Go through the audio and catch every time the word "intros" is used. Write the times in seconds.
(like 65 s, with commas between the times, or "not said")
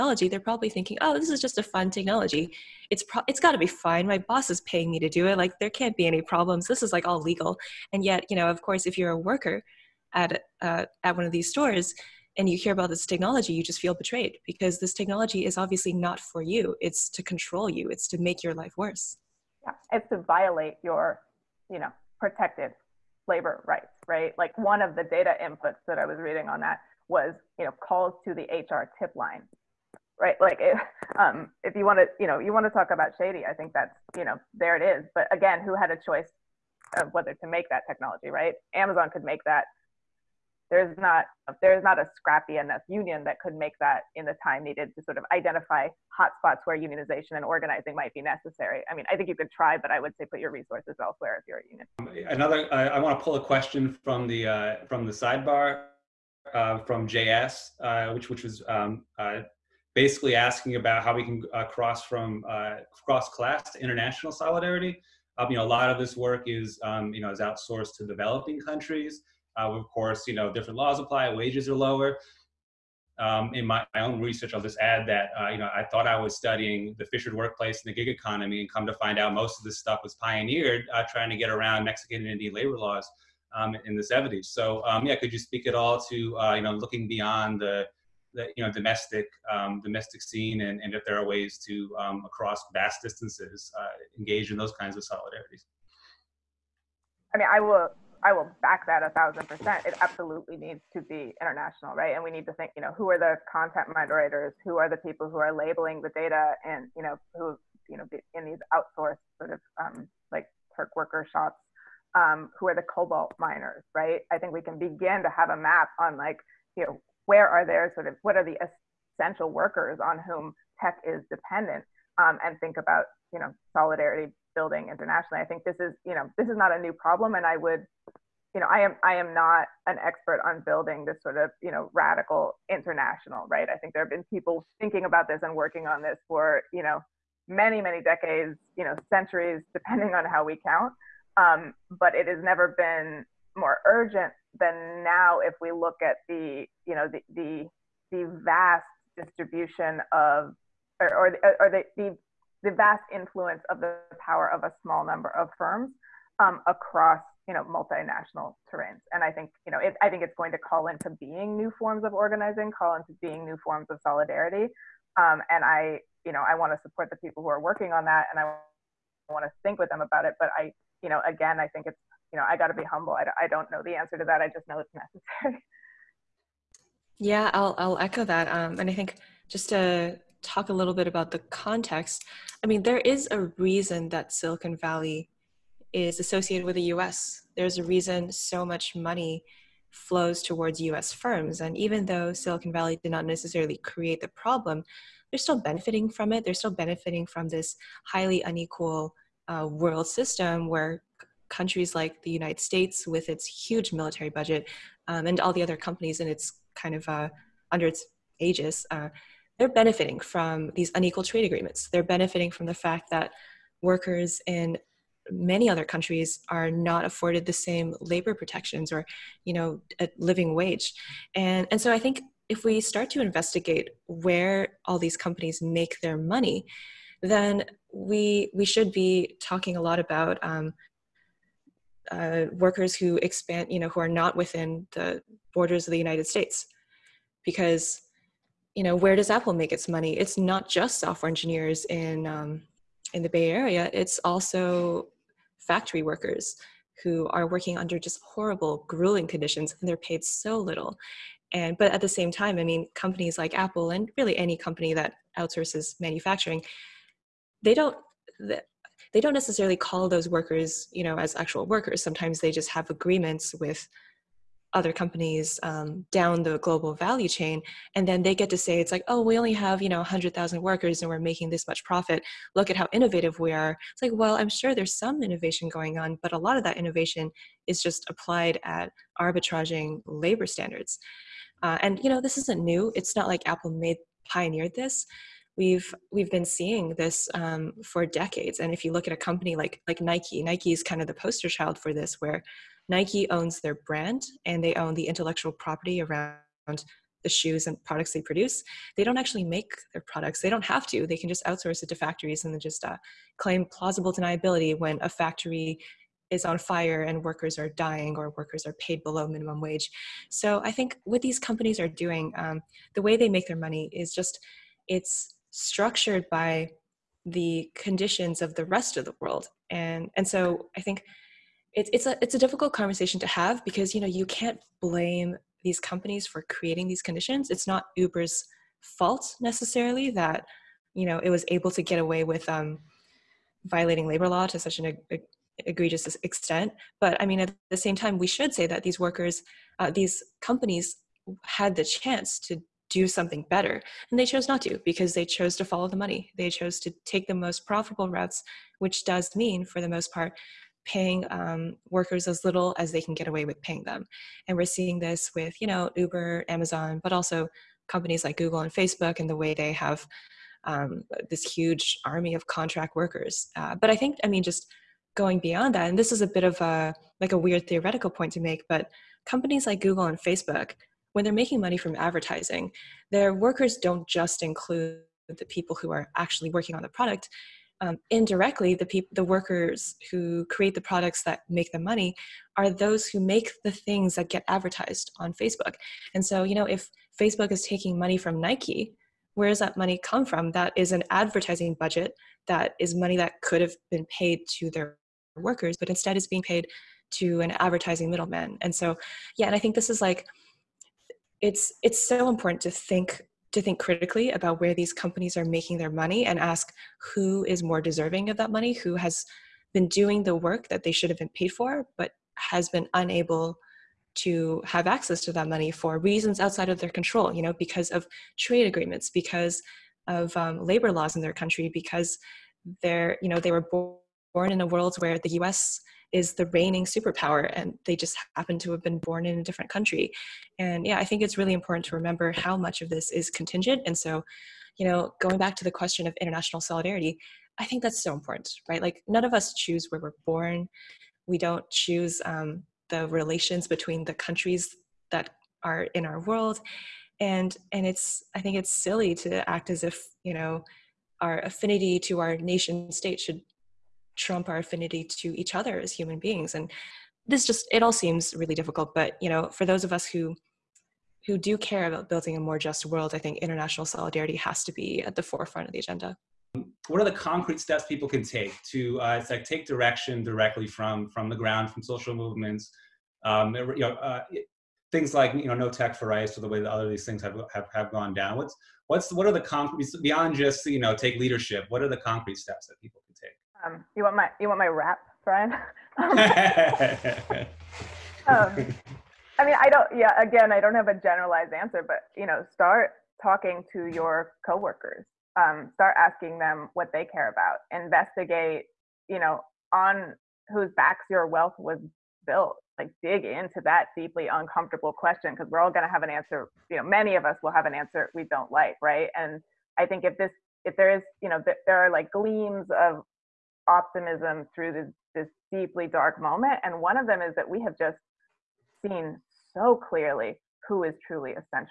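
not said.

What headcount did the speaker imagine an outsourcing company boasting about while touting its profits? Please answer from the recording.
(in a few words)
100,000.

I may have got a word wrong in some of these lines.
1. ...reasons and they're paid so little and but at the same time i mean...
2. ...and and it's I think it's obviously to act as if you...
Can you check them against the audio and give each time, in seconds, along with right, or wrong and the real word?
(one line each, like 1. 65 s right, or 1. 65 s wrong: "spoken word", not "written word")
1. 249 s wrong: "conditions", not "reasons"
2. 447 s wrong: "silly", not "obviously".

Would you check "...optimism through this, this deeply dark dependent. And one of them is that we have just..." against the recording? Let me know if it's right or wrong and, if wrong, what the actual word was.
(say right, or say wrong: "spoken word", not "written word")
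wrong: "moment", not "dependent".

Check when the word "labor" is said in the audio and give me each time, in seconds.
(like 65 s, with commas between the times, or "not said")
23 s, 82 s, 218 s, 280 s, 334 s, 420 s.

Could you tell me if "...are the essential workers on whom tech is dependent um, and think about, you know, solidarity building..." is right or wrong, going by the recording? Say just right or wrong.
right.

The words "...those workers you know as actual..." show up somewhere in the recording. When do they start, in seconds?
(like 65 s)
260 s.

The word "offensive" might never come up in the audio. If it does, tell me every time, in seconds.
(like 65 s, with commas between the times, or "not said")
not said.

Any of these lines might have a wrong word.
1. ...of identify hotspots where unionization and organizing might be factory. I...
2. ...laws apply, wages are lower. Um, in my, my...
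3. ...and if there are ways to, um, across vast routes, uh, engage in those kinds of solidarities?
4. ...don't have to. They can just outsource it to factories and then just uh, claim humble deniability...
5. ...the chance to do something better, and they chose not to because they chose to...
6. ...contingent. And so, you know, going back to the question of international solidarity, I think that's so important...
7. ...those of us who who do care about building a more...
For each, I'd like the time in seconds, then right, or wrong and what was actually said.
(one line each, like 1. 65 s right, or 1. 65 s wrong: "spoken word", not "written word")
1. 45 s wrong: "necessary", not "factory"
2. 70 s right
3. 90 s wrong: "distances", not "routes"
4. 300 s wrong: "plausible", not "humble"
5. 341 s right
6. 433 s right
7. 459 s right.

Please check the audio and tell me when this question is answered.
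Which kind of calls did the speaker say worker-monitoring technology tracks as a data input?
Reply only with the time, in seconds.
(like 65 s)
27 s.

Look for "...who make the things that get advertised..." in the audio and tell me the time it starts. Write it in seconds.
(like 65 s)
383 s.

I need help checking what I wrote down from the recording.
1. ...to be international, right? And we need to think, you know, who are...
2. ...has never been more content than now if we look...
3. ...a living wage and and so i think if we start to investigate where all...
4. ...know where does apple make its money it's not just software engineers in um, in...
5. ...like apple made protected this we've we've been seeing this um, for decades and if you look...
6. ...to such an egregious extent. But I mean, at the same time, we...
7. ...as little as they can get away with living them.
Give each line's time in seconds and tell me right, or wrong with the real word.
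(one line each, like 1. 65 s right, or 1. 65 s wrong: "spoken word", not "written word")
1. 100 s right
2. 142 s wrong: "urgent", not "content"
3. 220 s right
4. 238 s right
5. 283 s wrong: "pioneered", not "protected"
6. 334 s right
7. 352 s wrong: "paying", not "living".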